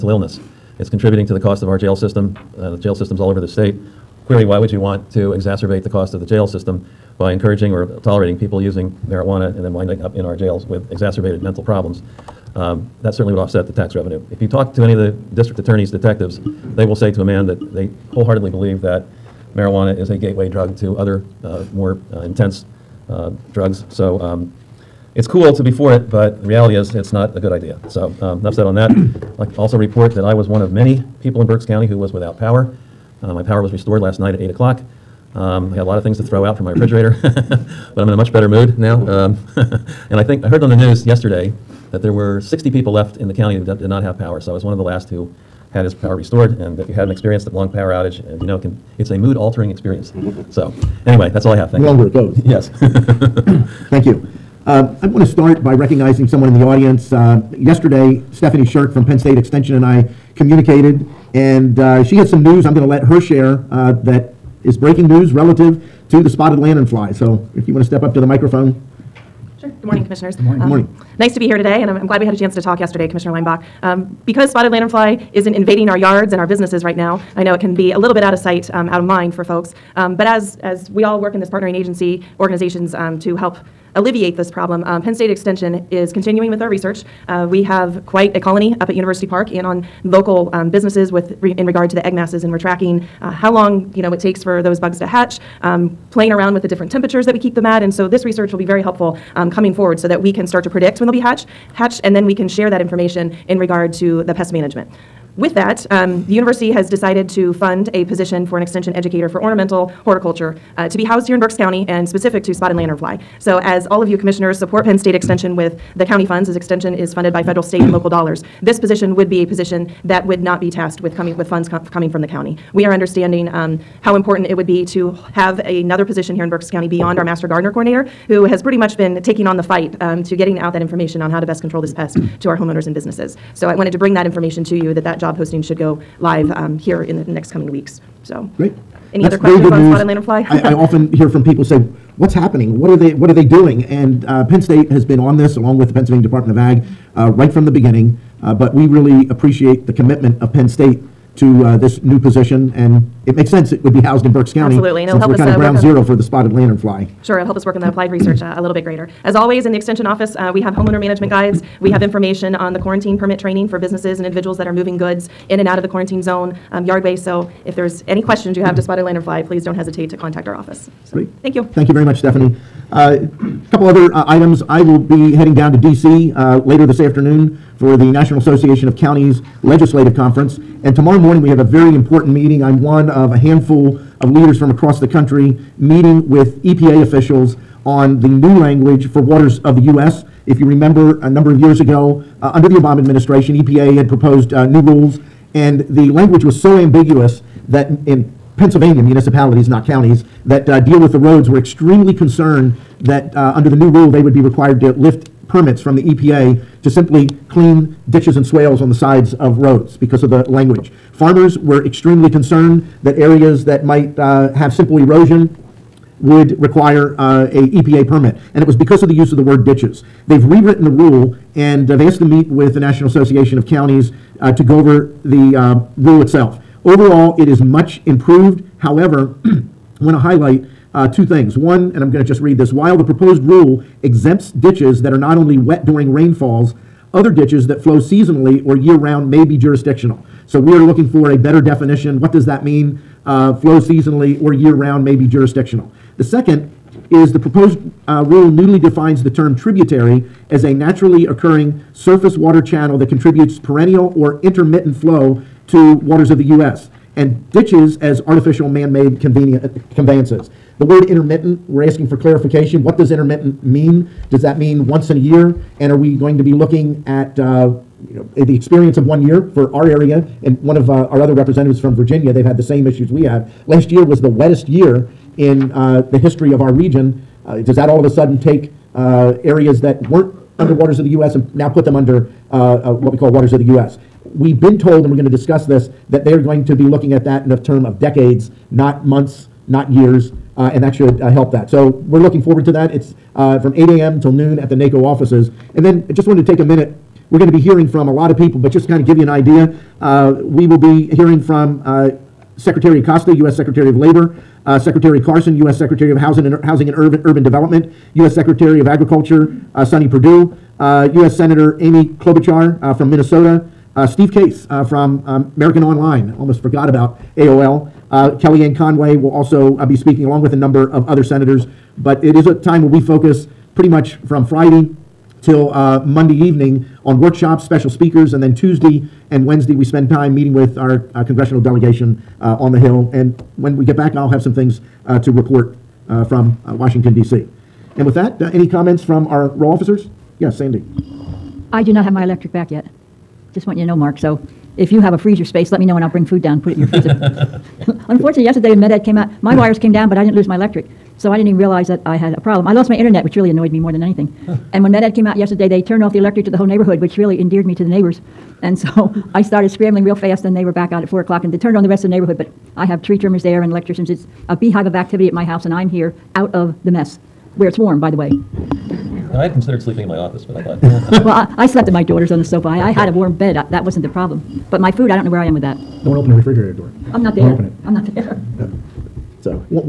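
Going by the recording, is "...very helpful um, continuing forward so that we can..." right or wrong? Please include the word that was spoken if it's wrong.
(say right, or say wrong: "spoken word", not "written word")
wrong: "coming", not "continuing".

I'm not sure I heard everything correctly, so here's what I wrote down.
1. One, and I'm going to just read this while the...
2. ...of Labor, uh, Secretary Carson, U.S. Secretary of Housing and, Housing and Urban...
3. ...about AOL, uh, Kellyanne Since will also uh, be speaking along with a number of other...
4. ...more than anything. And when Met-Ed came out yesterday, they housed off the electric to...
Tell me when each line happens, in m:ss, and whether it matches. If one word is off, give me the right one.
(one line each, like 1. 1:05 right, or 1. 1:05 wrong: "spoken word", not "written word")
1. 3:51 right
2. 5:03 right
3. 5:16 wrong: "Conway", not "Since"
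4. 5:53 wrong: "turned", not "housed".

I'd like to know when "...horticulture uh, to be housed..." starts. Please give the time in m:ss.
1:50.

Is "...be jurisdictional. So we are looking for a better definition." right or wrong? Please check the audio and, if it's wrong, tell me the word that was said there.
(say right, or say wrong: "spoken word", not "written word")
right.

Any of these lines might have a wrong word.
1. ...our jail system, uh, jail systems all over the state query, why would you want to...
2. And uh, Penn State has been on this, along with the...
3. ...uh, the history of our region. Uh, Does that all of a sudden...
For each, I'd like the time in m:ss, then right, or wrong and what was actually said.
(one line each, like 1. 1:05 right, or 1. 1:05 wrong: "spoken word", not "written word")
1. 0:01 right
2. 2:23 right
3. 4:35 right.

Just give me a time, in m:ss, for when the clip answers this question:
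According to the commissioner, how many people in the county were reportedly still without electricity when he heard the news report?
0:42.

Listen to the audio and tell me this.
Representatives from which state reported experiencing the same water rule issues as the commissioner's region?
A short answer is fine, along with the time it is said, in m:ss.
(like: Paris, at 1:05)
Virginia, at 4:31.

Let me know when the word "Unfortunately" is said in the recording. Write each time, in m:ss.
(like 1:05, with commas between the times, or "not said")
5:48.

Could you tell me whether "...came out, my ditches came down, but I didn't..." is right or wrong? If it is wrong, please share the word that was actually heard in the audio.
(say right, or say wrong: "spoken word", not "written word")
wrong: "wires", not "ditches".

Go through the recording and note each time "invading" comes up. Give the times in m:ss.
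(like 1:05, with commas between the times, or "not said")
1:15.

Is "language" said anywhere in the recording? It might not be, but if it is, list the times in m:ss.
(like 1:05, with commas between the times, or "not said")
3:08, 3:16, 3:30.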